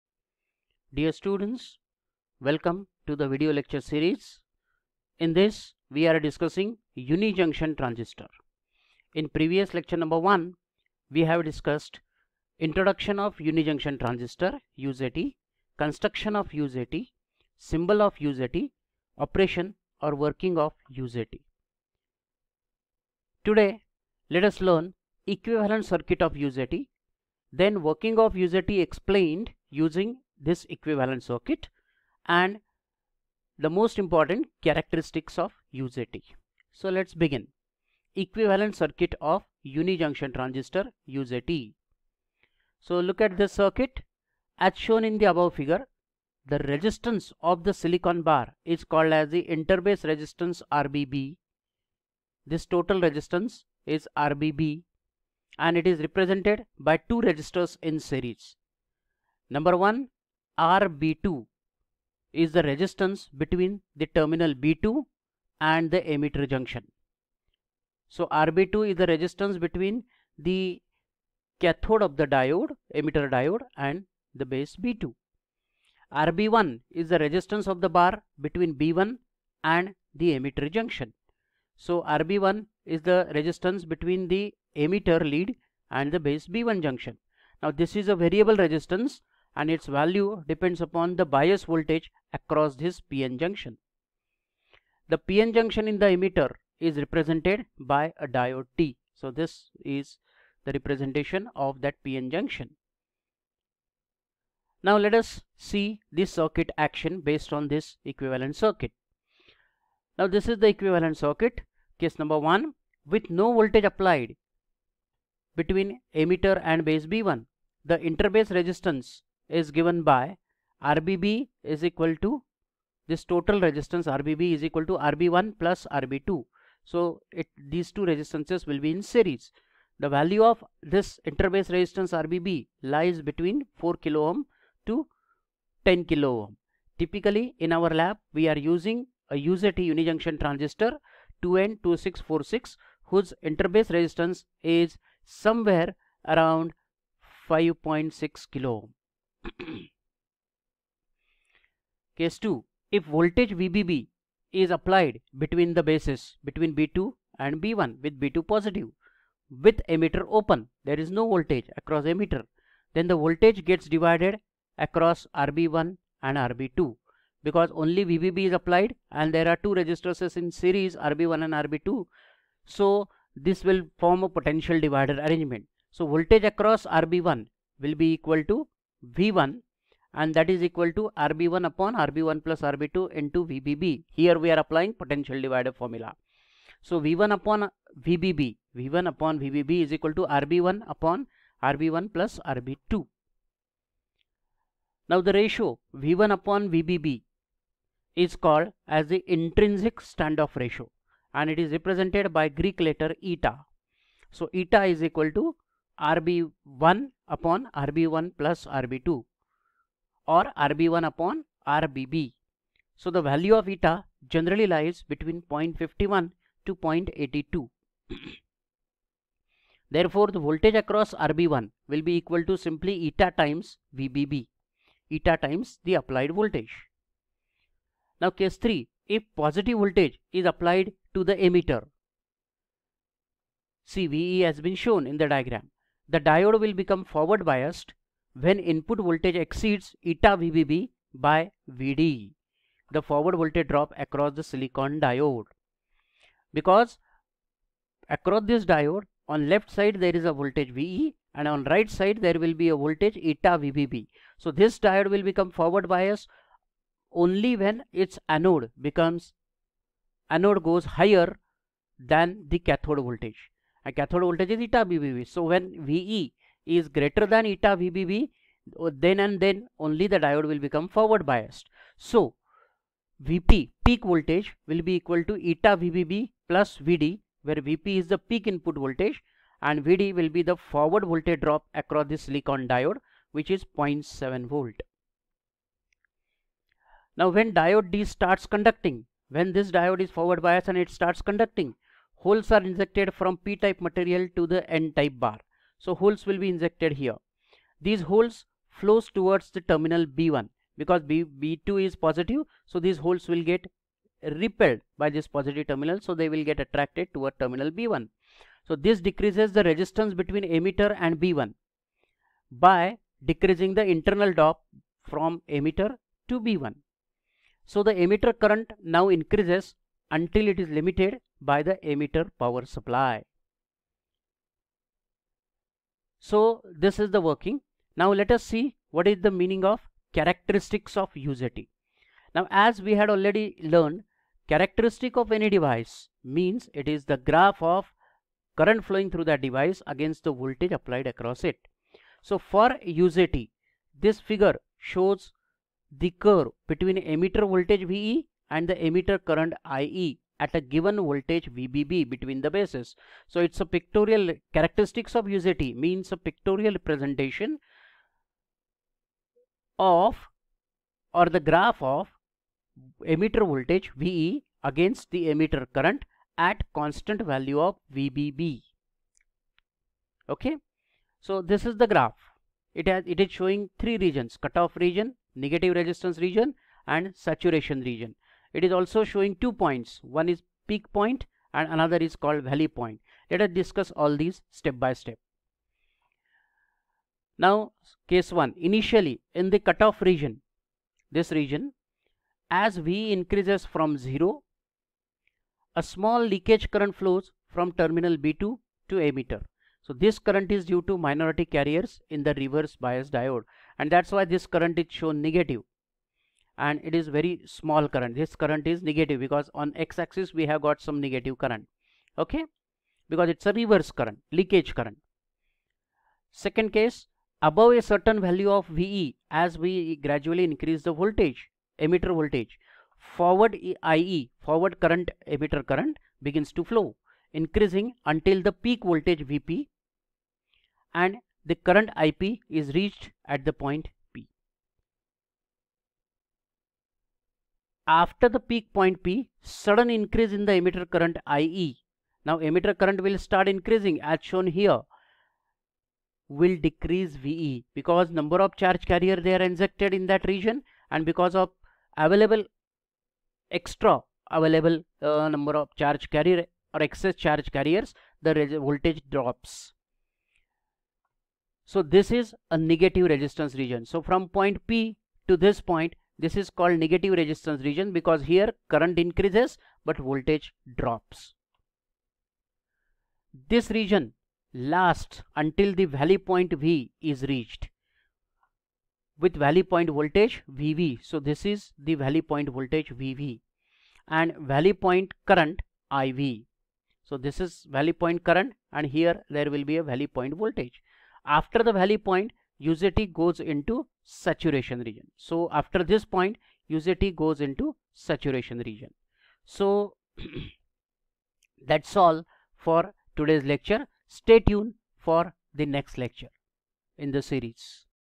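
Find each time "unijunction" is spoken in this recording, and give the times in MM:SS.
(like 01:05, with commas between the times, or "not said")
00:06, 00:13, 00:39, 02:19.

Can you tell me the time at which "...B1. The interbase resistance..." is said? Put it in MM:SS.
01:57.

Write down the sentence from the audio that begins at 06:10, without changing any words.
Okay, so this is the graph.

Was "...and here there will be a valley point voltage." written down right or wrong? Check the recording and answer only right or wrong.
right.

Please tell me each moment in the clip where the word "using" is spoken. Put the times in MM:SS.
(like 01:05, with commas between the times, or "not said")
00:29, 02:18.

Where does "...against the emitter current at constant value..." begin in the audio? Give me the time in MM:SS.
06:04.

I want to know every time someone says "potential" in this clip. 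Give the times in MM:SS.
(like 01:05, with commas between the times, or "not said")
02:54, 03:04.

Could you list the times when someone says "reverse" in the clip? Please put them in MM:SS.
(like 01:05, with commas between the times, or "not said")
06:42, 06:53.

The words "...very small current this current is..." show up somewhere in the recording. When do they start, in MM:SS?
06:47.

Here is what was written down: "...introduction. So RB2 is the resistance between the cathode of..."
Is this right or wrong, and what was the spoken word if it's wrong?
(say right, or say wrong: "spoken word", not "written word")
wrong: "junction", not "introduction".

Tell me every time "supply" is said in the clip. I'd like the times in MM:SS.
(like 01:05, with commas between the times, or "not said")
05:22.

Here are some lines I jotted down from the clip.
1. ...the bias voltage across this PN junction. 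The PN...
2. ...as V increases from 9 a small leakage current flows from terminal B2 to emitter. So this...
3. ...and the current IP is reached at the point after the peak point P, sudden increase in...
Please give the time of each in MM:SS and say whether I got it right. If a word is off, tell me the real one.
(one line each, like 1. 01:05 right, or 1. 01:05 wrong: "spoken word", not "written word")
1. 01:31 right
2. 06:32 wrong: "0", not "9"
3. 07:10 right.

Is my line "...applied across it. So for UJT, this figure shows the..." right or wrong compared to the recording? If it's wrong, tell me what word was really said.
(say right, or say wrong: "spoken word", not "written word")
right.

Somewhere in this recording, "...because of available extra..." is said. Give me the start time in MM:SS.
07:31.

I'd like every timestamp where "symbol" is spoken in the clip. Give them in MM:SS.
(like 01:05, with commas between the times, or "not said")
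00:17.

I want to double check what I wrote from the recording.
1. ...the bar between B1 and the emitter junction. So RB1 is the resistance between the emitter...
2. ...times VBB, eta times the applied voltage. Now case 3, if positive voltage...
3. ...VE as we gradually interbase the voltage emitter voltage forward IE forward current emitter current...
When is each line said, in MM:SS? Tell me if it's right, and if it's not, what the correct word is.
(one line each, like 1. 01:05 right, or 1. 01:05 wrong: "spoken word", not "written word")
1. 01:17 right
2. 03:43 right
3. 06:58 wrong: "increase", not "interbase".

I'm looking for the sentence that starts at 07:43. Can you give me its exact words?
So from point P to this point this is called negative resistance region because here current increases but voltage drops.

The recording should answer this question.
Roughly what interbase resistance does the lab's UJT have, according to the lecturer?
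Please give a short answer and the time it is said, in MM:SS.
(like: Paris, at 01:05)
5.6 kilo ohm, at 02:27.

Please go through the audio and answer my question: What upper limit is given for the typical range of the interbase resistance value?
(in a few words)
10 kilo ohm.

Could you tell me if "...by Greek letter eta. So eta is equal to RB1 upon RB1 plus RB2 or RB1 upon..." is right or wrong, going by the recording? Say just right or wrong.
right.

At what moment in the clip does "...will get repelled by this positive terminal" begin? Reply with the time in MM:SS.
05:03.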